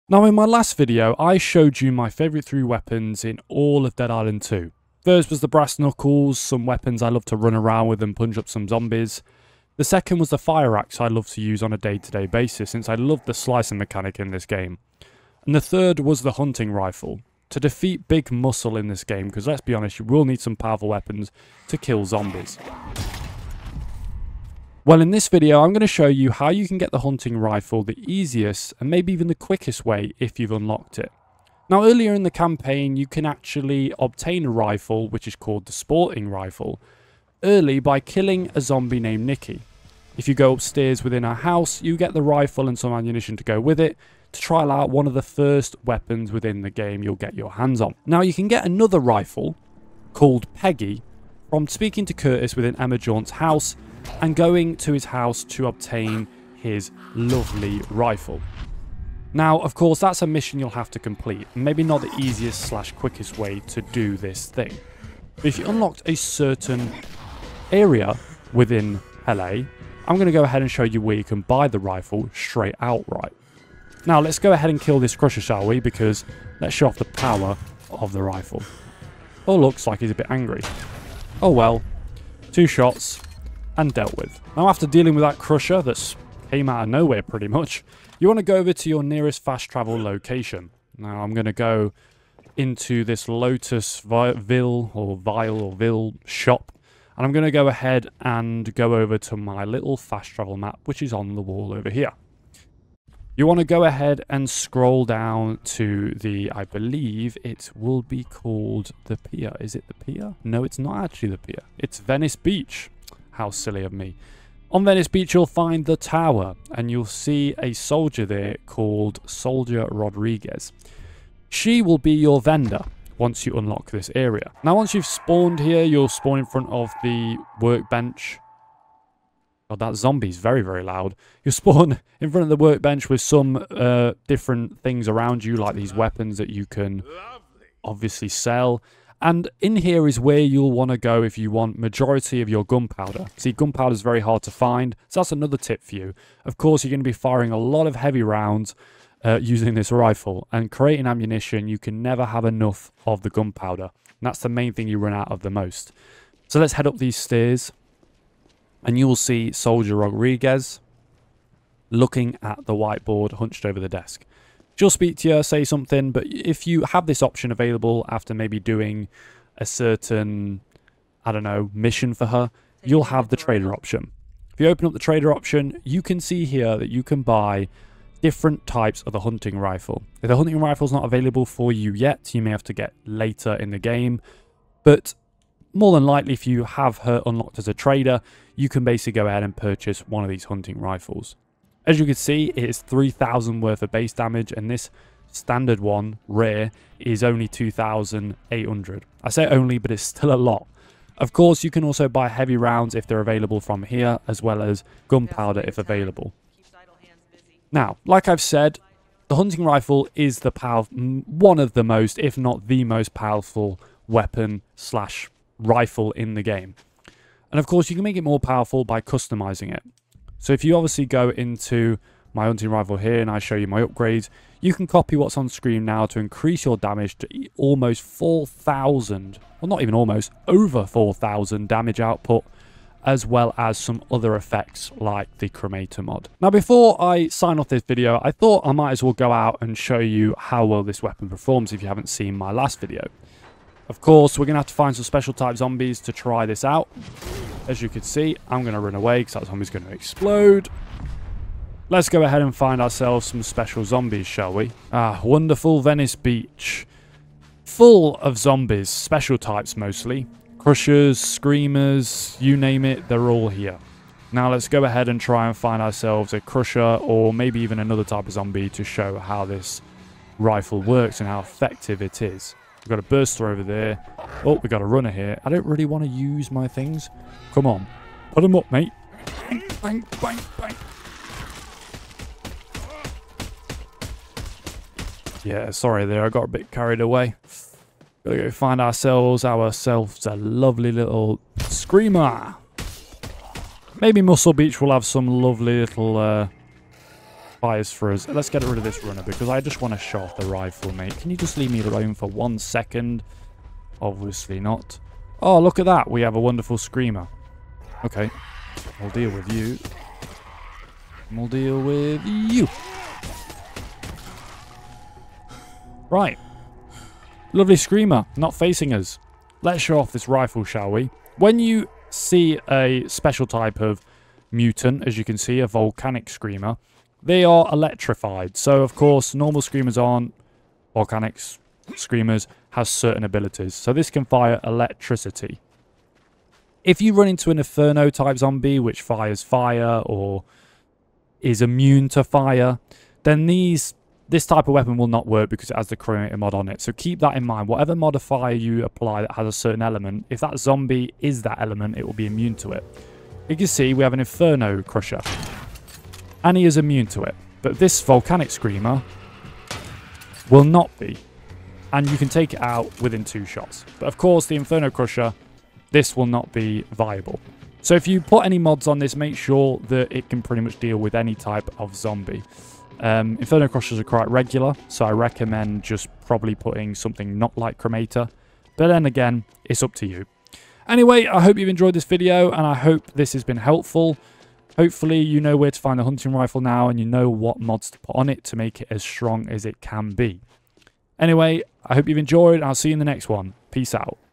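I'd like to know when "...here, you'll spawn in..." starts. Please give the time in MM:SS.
02:05.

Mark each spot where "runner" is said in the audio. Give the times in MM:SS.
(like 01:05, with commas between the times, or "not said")
04:34, 04:59.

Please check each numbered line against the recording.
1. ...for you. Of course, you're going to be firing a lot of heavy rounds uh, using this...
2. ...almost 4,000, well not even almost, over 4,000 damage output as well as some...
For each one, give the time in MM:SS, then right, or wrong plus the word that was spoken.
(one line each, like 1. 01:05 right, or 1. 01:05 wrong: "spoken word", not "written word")
1. 02:25 right
2. 03:47 right.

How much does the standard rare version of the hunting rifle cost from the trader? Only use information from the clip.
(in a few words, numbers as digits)
2,800.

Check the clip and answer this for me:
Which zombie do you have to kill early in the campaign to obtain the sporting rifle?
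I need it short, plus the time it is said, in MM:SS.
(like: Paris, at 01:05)
Nikki, at 00:39.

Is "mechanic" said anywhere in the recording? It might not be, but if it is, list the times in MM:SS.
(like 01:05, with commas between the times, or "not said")
00:13.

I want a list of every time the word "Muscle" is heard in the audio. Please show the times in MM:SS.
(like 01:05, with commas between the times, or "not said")
00:18, 04:54.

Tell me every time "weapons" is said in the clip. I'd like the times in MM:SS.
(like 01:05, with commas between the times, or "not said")
00:02, 00:06, 00:20, 00:45, 02:15, 03:34, 04:01, 05:44.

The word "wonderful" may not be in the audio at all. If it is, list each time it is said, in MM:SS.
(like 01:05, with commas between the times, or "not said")
04:15, 05:06.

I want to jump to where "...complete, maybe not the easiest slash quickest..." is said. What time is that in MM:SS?
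01:00.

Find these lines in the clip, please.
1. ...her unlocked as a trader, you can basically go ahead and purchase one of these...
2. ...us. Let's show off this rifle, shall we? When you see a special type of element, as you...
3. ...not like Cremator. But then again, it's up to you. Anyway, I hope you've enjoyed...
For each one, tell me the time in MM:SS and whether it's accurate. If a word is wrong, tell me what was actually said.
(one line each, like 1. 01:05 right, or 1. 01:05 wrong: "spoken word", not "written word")
1. 03:06 right
2. 05:18 wrong: "mutant", not "element"
3. 06:17 right.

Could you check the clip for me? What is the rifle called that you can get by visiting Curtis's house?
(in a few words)
Peggy.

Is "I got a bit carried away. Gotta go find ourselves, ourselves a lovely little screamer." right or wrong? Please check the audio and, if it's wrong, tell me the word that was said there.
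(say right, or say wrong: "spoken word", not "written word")
right.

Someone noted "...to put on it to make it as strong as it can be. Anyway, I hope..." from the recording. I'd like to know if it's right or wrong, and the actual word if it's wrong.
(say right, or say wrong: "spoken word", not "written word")
right.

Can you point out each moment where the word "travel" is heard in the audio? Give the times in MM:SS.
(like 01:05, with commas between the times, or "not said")
01:29, 01:40.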